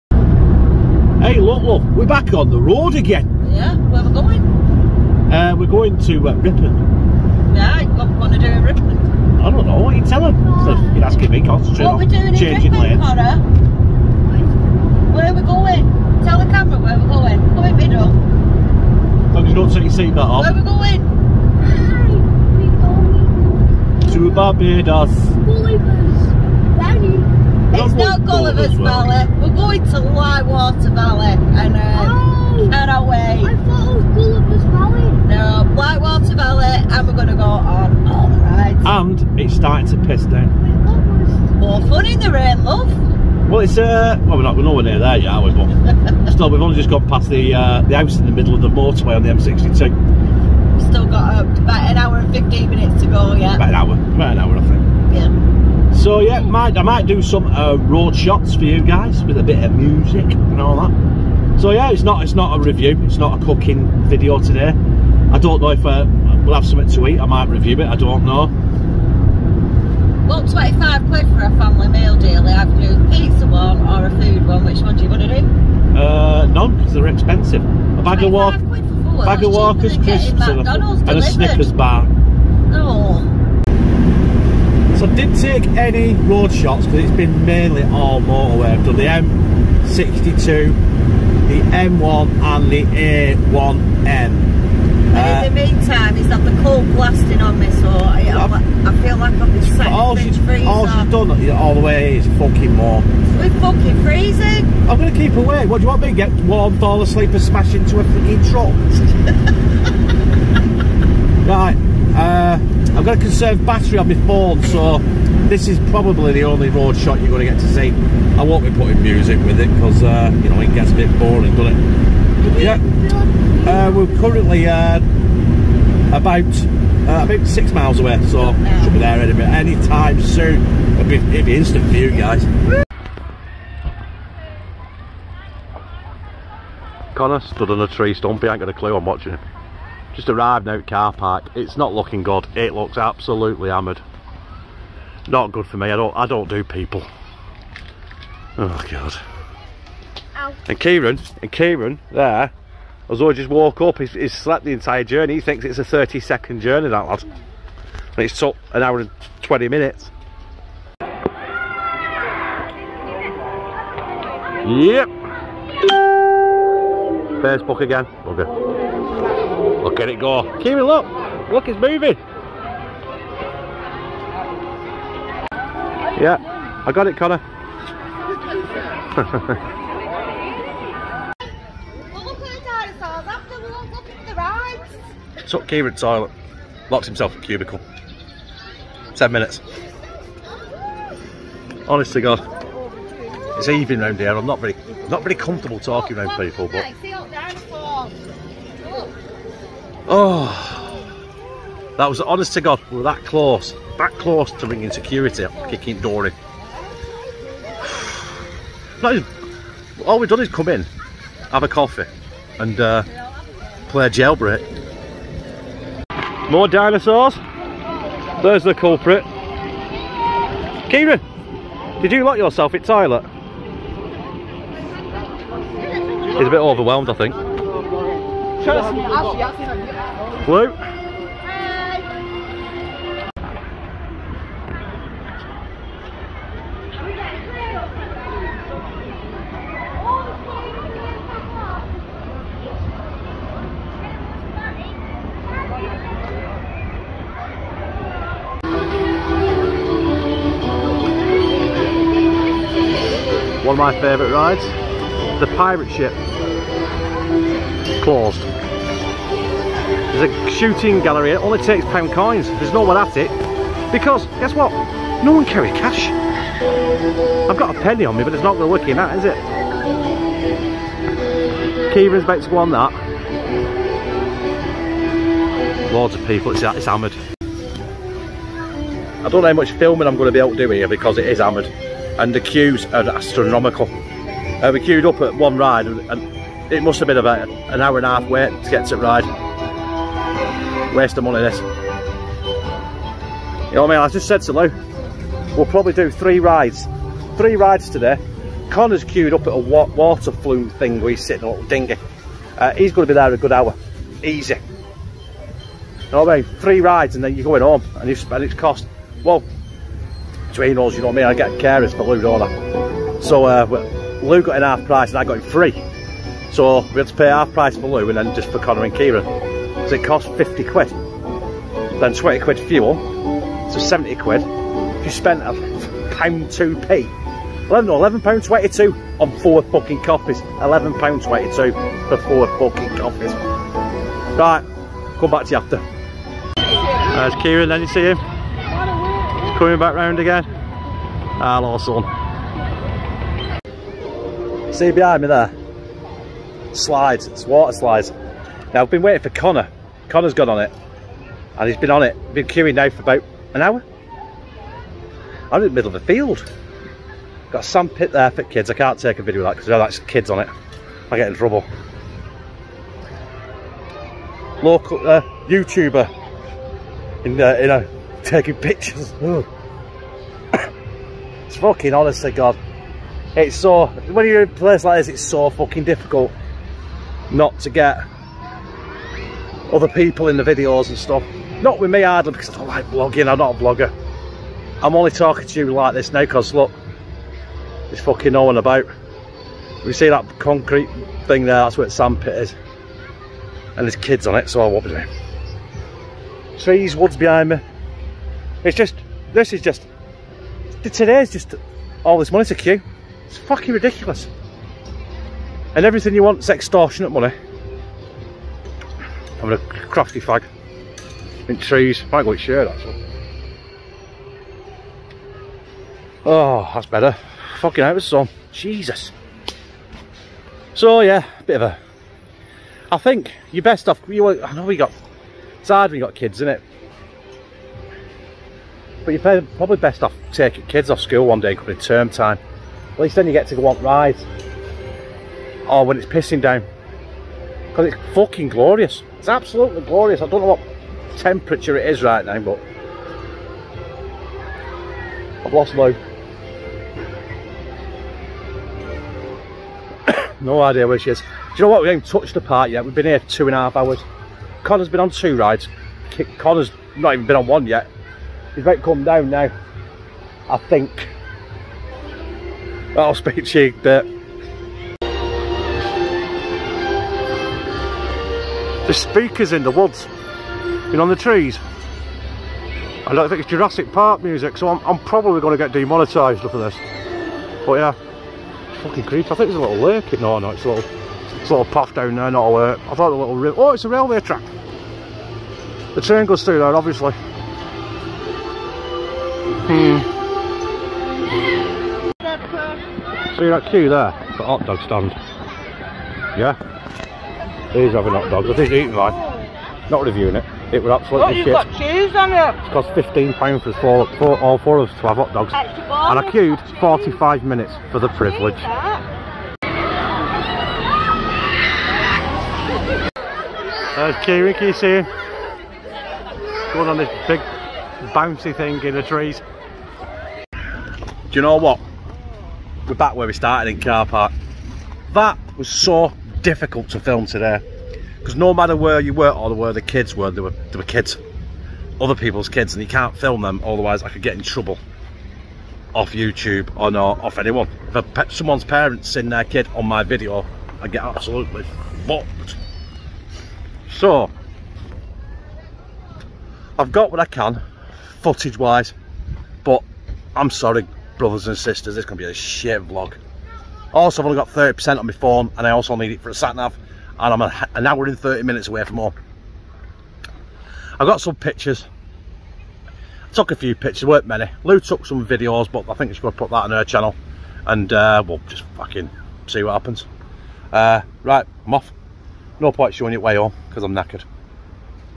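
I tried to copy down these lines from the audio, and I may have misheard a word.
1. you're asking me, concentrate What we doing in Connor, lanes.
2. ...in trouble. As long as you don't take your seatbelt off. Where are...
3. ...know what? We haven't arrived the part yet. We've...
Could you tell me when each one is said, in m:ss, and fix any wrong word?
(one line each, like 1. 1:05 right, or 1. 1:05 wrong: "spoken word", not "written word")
1. 0:10 wrong: "Ripon", not "Connor"
2. 0:17 wrong: "middle", not "trouble"
3. 7:31 wrong: "touched", not "arrived".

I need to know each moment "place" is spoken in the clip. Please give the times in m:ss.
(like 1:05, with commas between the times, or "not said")
6:14.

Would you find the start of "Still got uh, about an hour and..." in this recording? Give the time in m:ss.
0:50.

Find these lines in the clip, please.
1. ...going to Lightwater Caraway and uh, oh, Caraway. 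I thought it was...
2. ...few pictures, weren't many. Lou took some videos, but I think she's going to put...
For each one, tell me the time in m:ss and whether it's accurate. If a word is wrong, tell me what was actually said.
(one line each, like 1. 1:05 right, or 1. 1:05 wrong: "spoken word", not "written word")
1. 0:29 wrong: "Valley", not "Caraway"
2. 9:23 right.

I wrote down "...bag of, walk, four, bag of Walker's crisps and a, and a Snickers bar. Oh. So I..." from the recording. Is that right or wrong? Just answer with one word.
right.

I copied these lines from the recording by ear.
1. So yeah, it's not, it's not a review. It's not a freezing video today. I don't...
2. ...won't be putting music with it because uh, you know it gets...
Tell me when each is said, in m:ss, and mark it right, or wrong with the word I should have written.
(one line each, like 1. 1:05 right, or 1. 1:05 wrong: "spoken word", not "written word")
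1. 1:01 wrong: "cooking", not "freezing"
2. 1:58 right.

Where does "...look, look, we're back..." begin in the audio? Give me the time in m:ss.
0:01.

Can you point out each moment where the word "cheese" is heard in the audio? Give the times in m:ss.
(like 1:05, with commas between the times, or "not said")
8:21.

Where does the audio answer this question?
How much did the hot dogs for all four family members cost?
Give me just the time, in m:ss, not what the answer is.
8:22.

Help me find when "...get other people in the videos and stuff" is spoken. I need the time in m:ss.
6:17.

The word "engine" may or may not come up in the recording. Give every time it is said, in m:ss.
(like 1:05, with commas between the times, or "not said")
not said.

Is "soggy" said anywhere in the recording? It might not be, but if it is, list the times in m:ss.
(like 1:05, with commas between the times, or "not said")
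not said.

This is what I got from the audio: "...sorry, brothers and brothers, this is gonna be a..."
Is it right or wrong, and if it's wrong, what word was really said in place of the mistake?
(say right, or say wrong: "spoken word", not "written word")
wrong: "sisters", not "brothers".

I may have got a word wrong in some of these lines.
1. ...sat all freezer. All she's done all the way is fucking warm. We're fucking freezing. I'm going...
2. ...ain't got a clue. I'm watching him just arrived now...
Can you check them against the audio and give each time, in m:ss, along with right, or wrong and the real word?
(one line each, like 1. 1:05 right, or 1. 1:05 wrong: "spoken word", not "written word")
1. 1:39 right
2. 2:18 right.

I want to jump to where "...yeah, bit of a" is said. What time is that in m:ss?
7:01.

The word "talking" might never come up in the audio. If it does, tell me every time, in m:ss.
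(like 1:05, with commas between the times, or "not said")
3:15, 6:25.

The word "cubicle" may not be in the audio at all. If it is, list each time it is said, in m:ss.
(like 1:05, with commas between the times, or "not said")
3:07.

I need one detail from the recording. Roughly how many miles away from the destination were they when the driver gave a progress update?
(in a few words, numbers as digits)
6.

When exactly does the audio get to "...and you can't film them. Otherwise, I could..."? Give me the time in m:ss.
8:52.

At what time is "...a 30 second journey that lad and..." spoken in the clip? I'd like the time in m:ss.
2:35.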